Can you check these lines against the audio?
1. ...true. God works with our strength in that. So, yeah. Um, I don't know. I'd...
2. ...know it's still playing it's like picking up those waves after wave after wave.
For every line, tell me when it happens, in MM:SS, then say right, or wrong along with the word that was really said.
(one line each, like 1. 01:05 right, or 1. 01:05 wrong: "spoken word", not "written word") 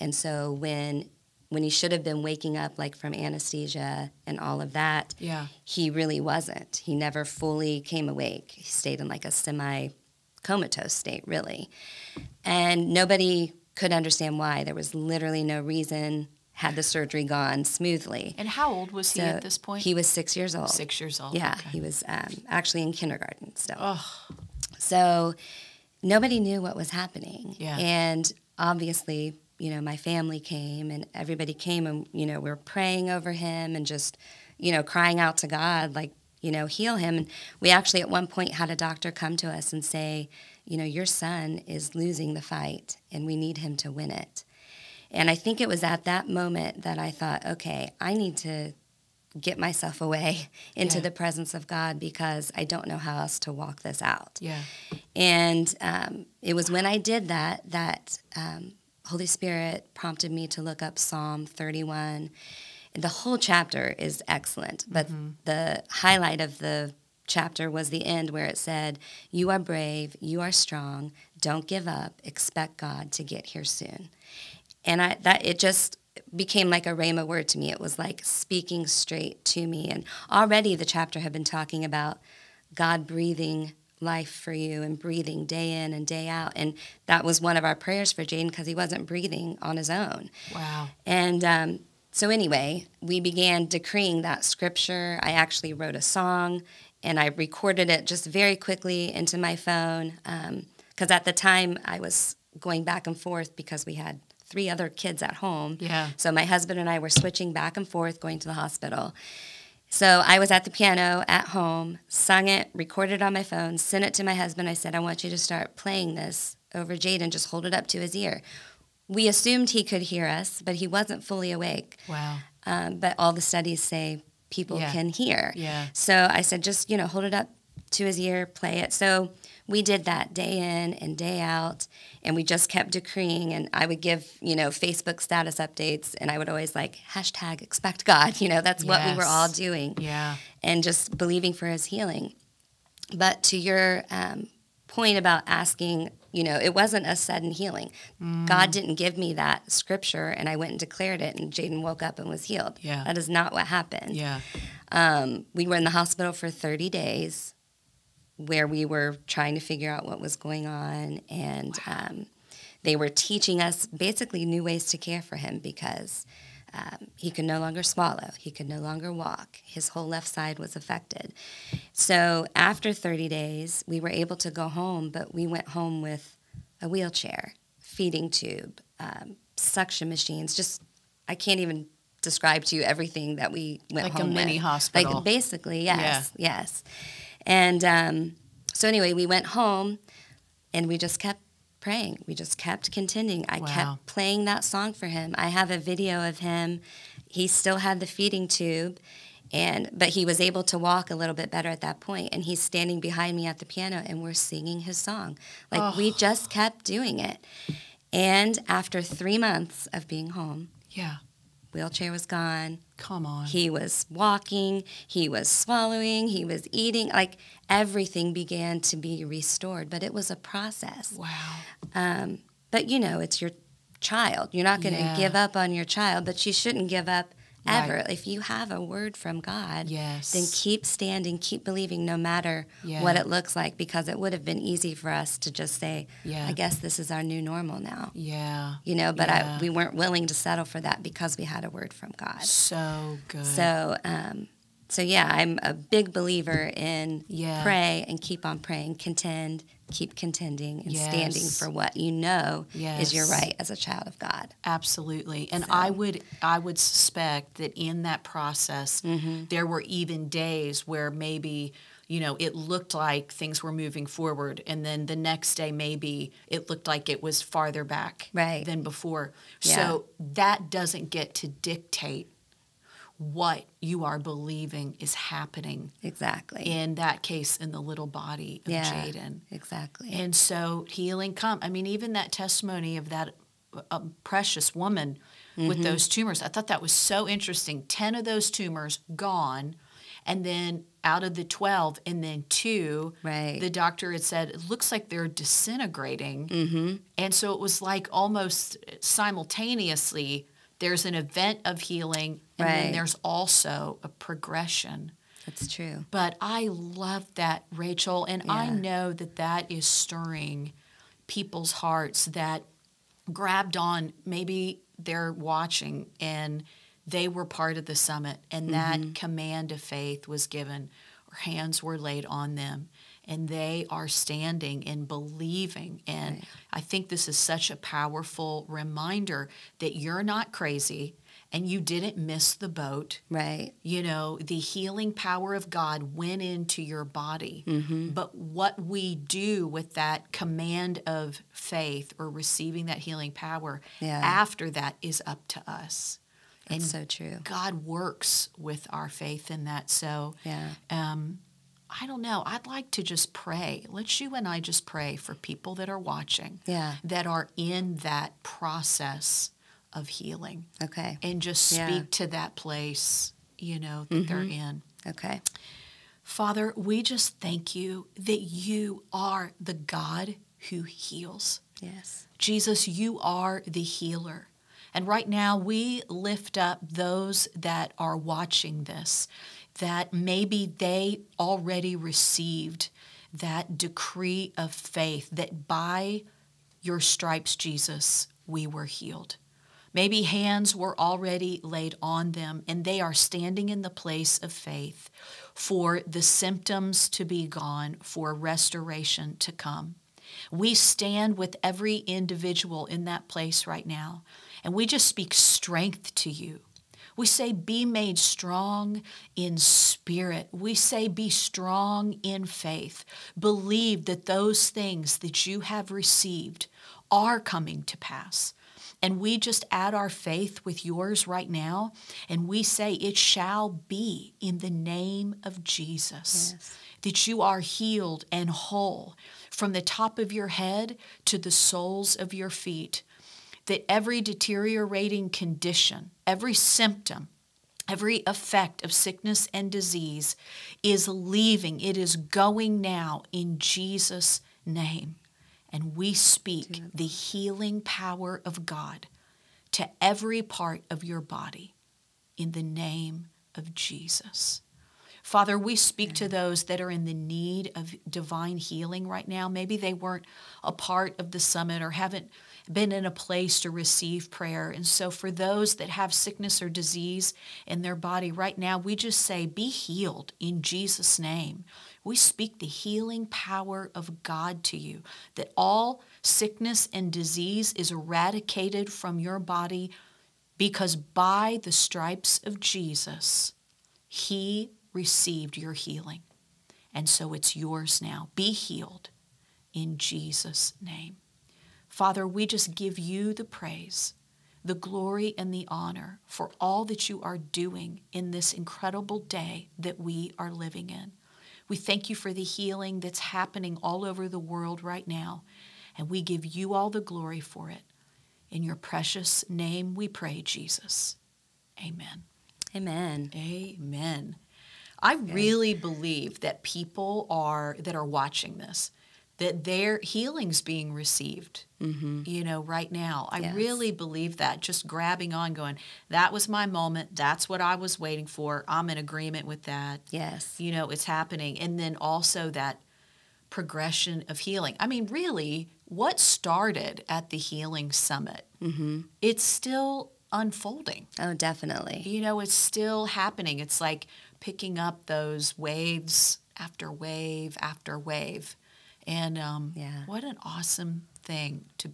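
1. 05:47 wrong: "faith", not "strength"
2. 09:02 wrong: "happening", not "playing".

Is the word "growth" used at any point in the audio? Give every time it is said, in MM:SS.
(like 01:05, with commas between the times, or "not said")
not said.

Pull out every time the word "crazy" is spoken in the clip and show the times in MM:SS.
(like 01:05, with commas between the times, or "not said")
05:30.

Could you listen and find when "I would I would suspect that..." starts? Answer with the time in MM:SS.
04:15.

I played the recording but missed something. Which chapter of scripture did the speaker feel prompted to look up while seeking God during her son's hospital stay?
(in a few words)
Psalm 31.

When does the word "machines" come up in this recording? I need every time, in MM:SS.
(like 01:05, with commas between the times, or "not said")
03:00.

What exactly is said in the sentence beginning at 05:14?
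Maybe they're watching and they were part of the summit and mm -hmm.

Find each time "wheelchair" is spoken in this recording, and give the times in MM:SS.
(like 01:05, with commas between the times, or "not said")
02:56, 03:31.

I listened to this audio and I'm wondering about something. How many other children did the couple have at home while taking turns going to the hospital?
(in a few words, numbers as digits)
3.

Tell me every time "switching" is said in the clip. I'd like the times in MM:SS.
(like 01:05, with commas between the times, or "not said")
01:47.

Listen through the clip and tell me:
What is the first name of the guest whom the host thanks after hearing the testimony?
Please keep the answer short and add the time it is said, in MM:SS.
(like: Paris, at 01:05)
Rachel, at 05:07.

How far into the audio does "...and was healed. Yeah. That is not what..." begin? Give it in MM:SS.
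02:32.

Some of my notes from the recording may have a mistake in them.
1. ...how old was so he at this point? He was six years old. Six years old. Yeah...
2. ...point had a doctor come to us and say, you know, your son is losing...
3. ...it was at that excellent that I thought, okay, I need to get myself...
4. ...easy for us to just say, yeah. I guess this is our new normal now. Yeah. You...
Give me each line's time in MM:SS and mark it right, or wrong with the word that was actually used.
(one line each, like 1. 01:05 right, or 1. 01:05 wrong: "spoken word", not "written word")
1. 00:18 right
2. 00:38 right
3. 00:45 wrong: "moment", not "excellent"
4. 03:54 right.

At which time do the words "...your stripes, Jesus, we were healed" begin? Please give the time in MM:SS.
06:26.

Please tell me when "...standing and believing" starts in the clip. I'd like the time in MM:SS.
05:24.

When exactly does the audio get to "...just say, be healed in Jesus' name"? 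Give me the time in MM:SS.
07:48.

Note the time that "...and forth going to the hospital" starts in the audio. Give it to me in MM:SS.
01:47.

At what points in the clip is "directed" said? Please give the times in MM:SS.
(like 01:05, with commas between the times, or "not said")
not said.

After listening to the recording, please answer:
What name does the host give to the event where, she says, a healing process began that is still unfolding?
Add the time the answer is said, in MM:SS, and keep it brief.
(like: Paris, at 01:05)
the healing summit, at 08:57.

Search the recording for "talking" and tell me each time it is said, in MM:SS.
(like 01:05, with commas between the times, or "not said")
01:21.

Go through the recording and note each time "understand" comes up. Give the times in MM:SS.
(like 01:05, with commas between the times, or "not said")
00:13.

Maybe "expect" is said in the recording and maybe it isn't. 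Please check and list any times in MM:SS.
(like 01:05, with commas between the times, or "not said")
01:12, 02:17.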